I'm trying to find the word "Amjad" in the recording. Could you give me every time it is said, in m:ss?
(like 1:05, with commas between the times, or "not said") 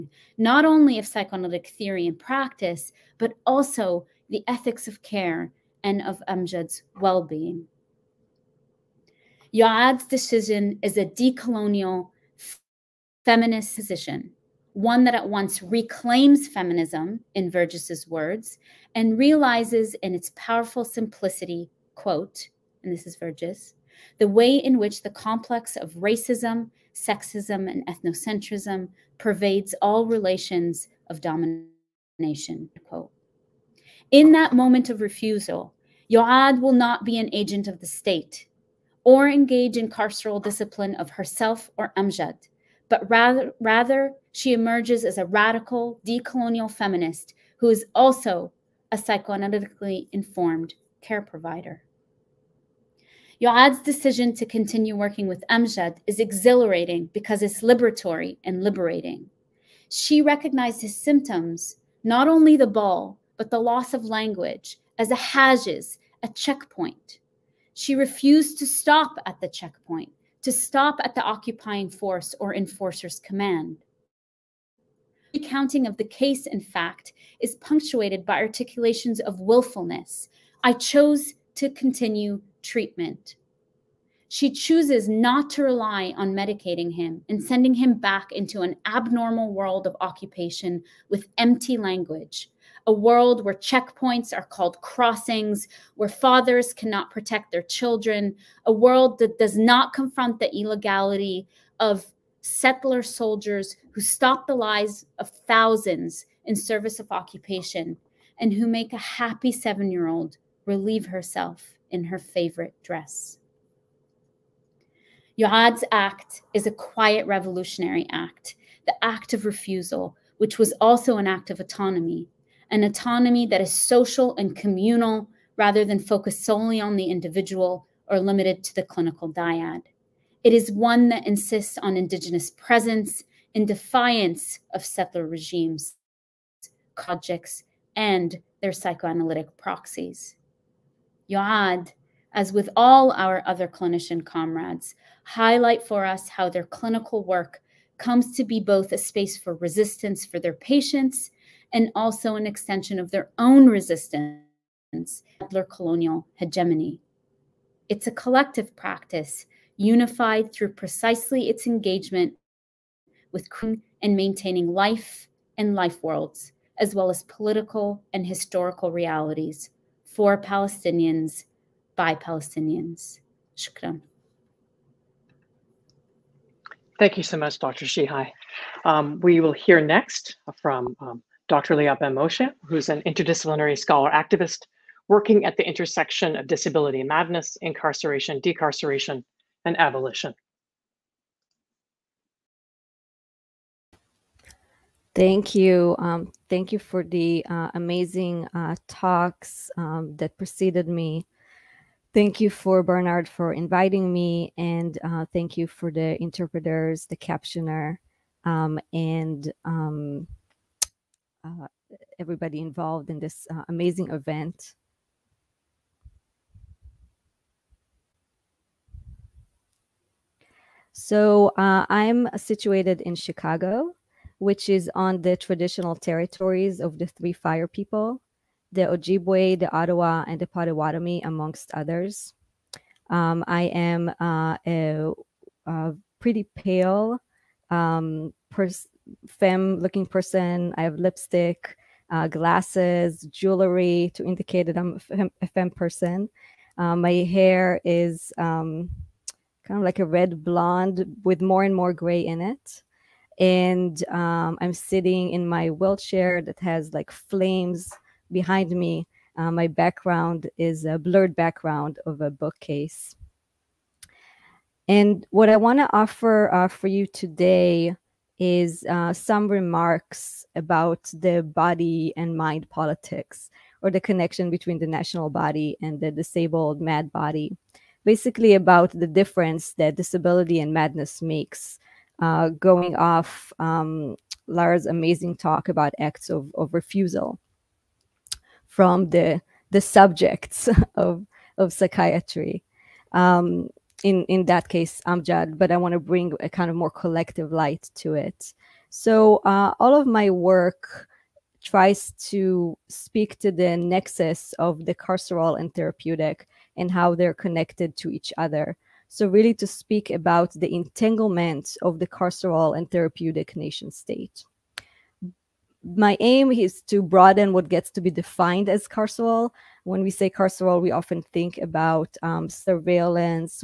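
0:06, 0:41, 0:55, 4:55.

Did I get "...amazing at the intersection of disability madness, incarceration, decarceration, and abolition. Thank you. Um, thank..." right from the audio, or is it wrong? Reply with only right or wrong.
wrong.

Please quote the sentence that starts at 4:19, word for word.
Uh, my background is a blurred background of a bookcase.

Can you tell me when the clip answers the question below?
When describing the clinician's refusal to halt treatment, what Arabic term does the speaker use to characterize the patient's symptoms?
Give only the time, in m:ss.
1:05.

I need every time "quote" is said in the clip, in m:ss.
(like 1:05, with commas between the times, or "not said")
0:21, 0:32.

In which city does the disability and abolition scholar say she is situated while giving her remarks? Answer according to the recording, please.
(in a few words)
Chicago.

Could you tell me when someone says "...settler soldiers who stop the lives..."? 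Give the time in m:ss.
1:42.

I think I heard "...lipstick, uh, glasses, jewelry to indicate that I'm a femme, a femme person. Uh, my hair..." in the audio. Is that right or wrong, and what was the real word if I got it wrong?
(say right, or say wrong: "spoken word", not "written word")
right.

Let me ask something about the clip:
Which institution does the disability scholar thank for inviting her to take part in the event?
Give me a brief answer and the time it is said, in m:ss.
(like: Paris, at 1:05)
Barnard, at 3:22.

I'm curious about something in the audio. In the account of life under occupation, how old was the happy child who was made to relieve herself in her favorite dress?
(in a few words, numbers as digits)
7.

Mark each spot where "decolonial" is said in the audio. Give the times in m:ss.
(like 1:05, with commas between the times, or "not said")
0:11, 0:46.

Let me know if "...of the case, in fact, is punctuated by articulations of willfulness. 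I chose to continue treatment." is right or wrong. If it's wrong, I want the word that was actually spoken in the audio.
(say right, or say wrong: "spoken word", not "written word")
right.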